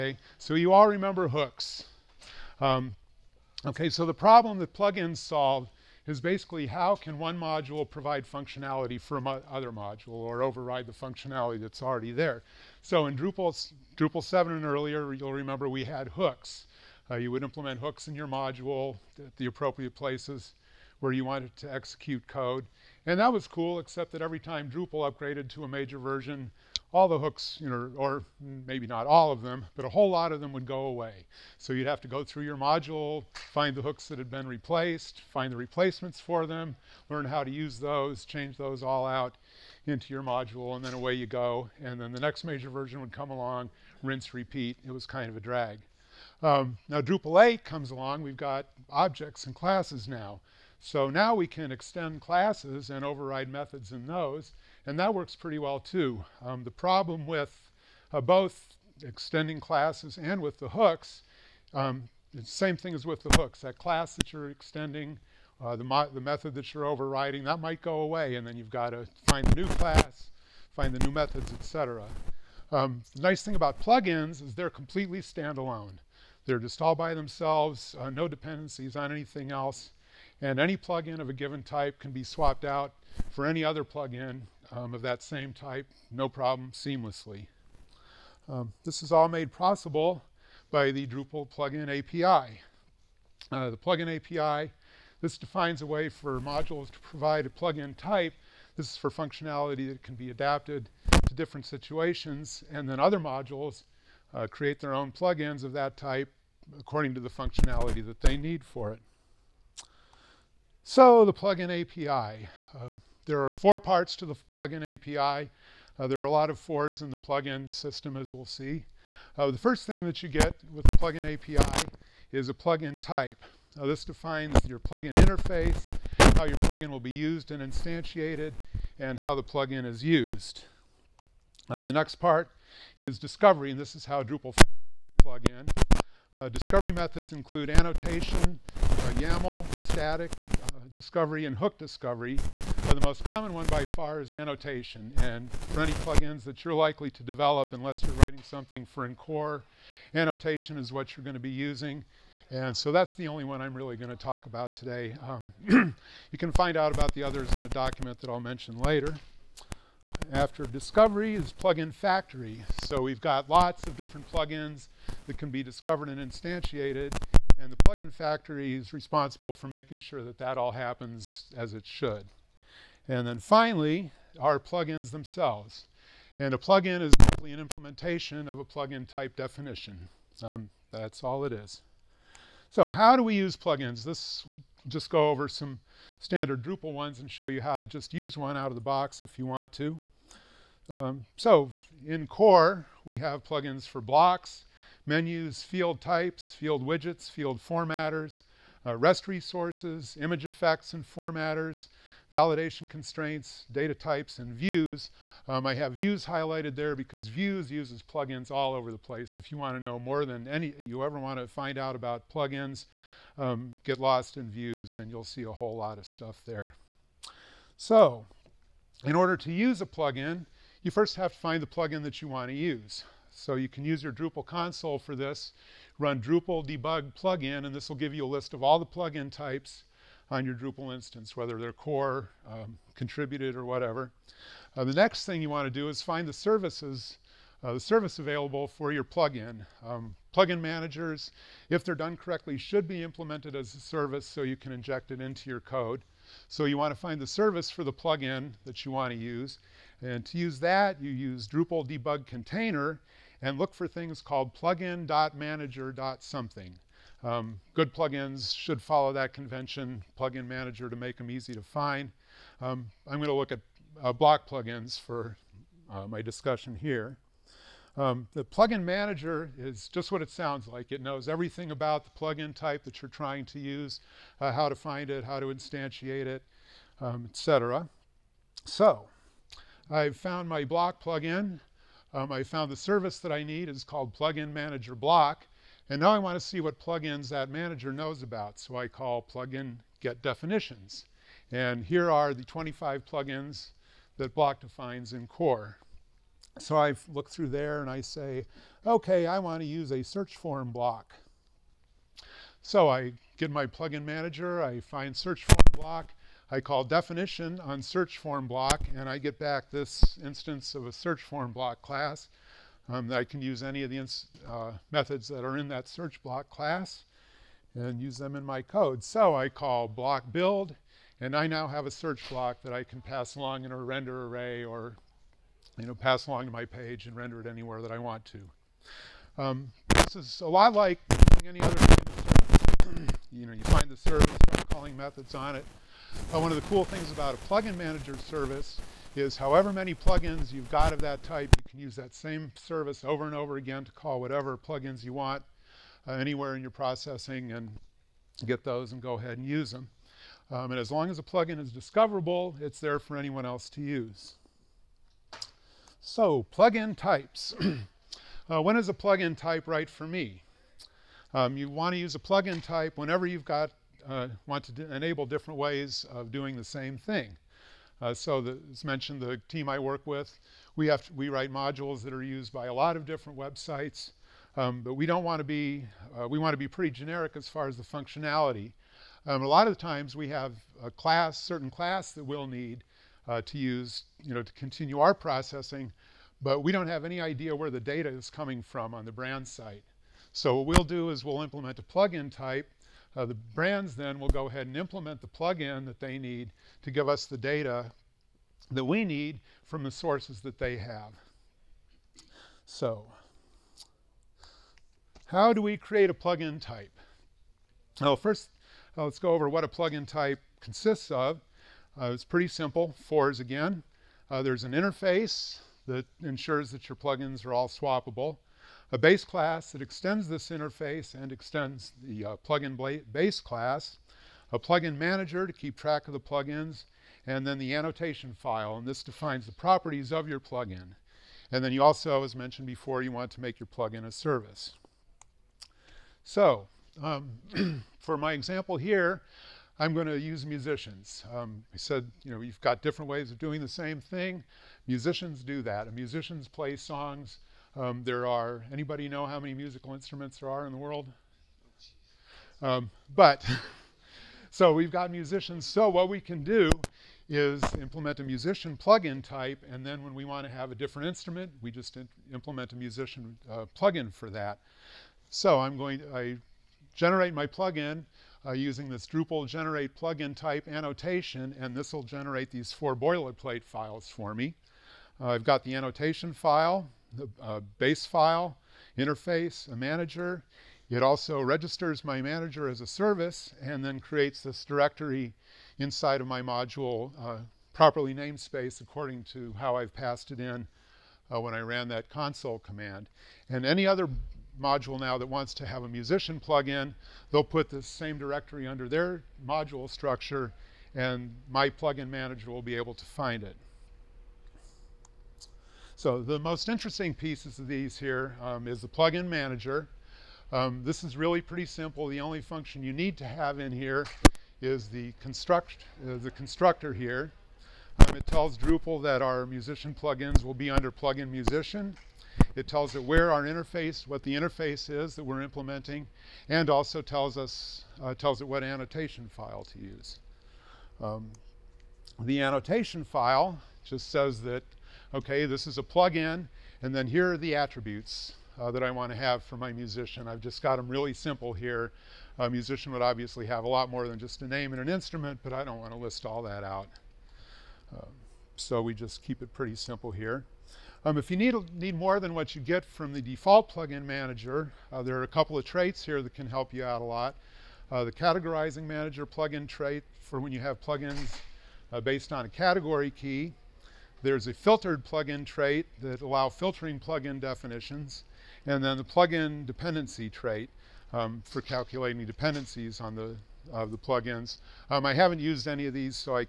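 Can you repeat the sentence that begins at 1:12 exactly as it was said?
Um, the nice thing about plugins is they're completely standalone.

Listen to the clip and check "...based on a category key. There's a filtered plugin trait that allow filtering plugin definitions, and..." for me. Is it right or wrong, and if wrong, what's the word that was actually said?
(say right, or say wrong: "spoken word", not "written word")
right.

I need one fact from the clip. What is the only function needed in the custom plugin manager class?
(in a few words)
The constructor.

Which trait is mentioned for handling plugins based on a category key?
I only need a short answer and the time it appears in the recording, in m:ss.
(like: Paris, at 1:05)
categorizing manager plugin trait, at 9:18.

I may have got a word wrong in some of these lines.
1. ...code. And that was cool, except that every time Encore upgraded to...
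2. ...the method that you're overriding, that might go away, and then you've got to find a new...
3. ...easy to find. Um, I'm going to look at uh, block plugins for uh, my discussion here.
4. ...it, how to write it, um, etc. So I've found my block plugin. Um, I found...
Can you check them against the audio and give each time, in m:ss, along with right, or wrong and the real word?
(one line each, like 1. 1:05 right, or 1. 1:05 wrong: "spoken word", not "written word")
1. 0:22 wrong: "Drupal", not "Encore"
2. 1:06 right
3. 4:21 right
4. 4:35 wrong: "instantiate", not "write".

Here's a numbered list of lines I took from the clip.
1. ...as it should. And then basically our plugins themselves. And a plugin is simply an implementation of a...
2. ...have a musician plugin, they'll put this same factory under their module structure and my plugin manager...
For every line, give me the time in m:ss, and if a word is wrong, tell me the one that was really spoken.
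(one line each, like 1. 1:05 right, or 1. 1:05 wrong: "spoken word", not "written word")
1. 2:51 wrong: "finally", not "basically"
2. 8:15 wrong: "directory", not "factory".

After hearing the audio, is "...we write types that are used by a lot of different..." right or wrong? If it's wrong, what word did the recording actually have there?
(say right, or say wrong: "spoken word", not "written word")
wrong: "modules", not "types".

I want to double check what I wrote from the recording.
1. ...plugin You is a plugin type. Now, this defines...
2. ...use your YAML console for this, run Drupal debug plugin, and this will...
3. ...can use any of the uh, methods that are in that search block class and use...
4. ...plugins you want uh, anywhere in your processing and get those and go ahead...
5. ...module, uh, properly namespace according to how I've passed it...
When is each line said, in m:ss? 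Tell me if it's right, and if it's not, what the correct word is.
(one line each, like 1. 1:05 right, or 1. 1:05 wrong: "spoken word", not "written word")
1. 2:00 wrong: "API", not "You"
2. 3:43 wrong: "Drupal", not "YAML"
3. 5:13 right
4. 5:44 right
5. 8:06 right.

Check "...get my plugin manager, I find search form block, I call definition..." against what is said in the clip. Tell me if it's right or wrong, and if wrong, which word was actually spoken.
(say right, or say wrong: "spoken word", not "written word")
right.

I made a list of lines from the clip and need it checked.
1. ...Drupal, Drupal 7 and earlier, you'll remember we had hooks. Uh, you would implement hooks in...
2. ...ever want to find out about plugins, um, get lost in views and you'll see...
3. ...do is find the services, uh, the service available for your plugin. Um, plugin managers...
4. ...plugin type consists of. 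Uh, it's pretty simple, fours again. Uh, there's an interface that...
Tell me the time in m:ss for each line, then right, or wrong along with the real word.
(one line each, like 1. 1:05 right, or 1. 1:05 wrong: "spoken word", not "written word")
1. 0:13 right
2. 3:31 right
3. 3:55 right
4. 6:49 right.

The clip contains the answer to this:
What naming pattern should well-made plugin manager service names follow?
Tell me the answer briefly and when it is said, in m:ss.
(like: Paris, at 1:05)
plugin.manager.something, at 4:14.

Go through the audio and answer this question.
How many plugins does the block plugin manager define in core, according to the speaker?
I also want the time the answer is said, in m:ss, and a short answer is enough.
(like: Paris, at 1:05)
25, at 4:52.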